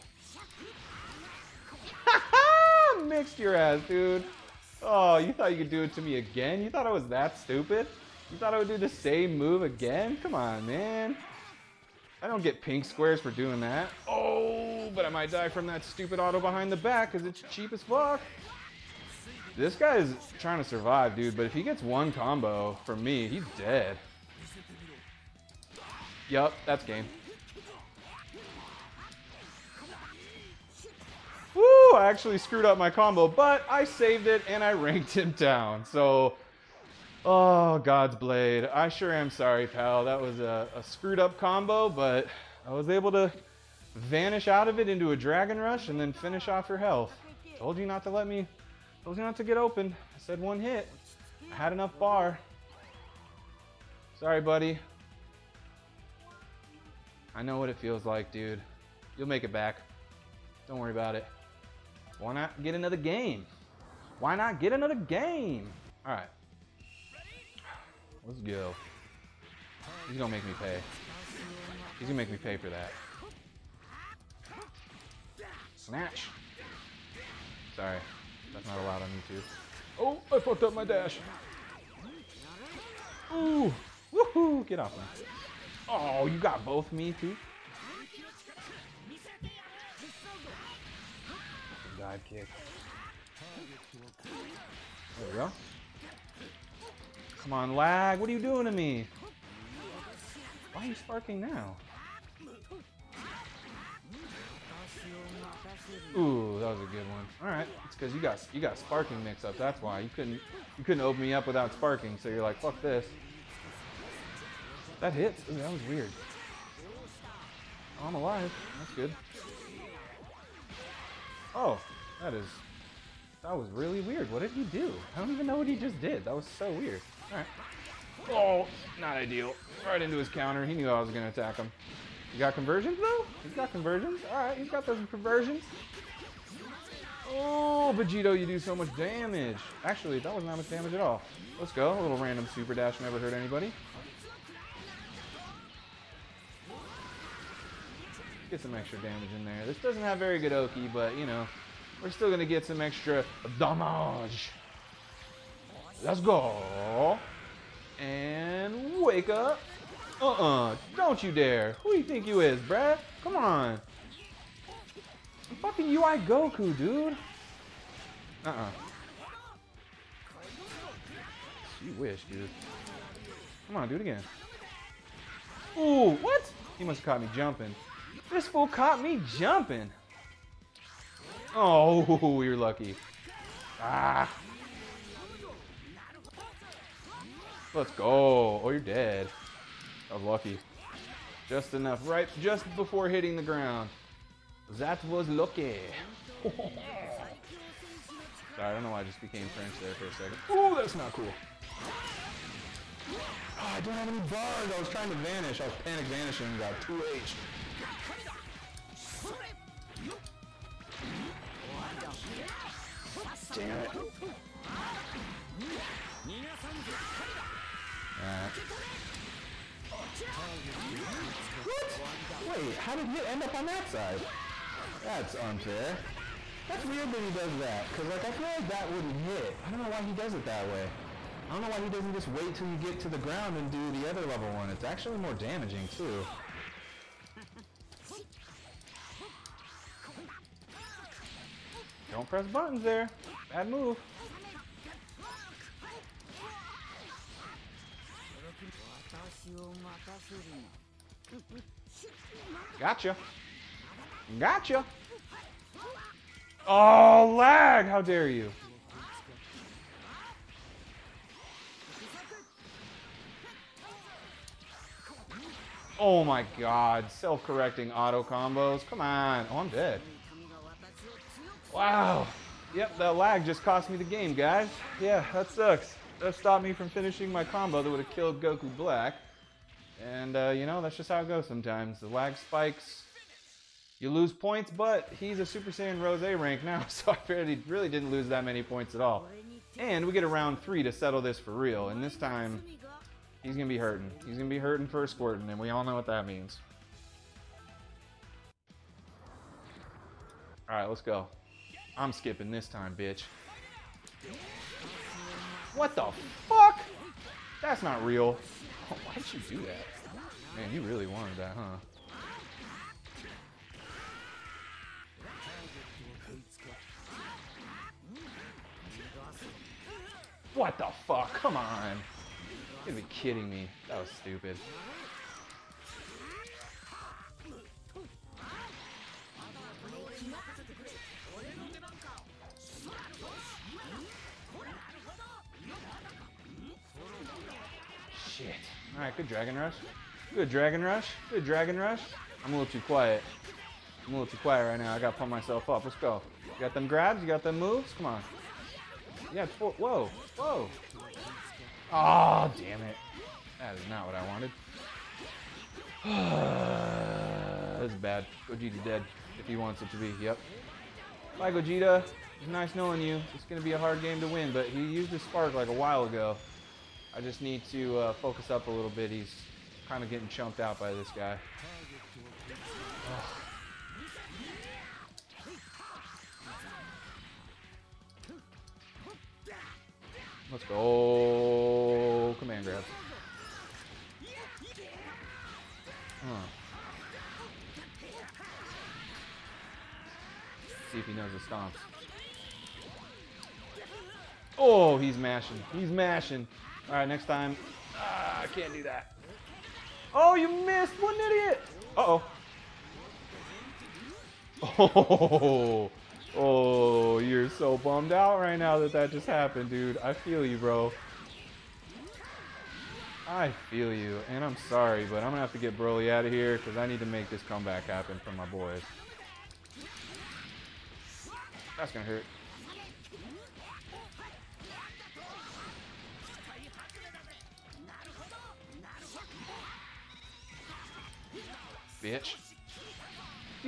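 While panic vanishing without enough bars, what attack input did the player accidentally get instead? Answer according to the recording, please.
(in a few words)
2H.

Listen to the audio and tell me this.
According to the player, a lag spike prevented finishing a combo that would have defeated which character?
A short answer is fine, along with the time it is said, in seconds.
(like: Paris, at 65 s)
Goku Black, at 278 s.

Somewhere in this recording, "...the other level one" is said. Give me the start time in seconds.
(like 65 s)
233 s.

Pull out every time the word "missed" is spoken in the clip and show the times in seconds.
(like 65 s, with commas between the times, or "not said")
400 s.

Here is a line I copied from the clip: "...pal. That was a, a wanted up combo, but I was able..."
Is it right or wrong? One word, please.
wrong.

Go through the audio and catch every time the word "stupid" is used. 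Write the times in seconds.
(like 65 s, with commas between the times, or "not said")
7 s, 15 s, 324 s.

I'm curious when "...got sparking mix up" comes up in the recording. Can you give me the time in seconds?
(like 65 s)
108 s.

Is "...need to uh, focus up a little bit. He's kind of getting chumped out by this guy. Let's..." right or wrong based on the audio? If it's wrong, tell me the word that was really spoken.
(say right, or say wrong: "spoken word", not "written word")
right.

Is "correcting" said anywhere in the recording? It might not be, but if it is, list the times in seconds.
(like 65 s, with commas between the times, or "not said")
267 s.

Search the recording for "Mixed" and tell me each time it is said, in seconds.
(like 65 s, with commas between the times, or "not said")
3 s.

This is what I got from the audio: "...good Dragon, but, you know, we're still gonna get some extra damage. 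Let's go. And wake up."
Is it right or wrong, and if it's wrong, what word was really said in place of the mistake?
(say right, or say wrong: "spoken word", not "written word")
wrong: "Oki", not "Dragon".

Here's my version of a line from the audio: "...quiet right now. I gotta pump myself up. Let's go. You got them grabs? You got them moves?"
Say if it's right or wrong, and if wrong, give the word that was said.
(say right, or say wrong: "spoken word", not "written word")
right.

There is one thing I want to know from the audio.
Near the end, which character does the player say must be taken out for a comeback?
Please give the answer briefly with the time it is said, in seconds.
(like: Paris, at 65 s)
Broly, at 415 s.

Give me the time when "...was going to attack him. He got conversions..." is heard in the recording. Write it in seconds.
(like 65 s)
130 s.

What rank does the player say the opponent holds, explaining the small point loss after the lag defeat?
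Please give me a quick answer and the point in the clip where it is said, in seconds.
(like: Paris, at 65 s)
Super Saiyan Rose, at 285 s.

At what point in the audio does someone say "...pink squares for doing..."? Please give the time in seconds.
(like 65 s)
12 s.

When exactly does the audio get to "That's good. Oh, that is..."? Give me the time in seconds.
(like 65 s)
118 s.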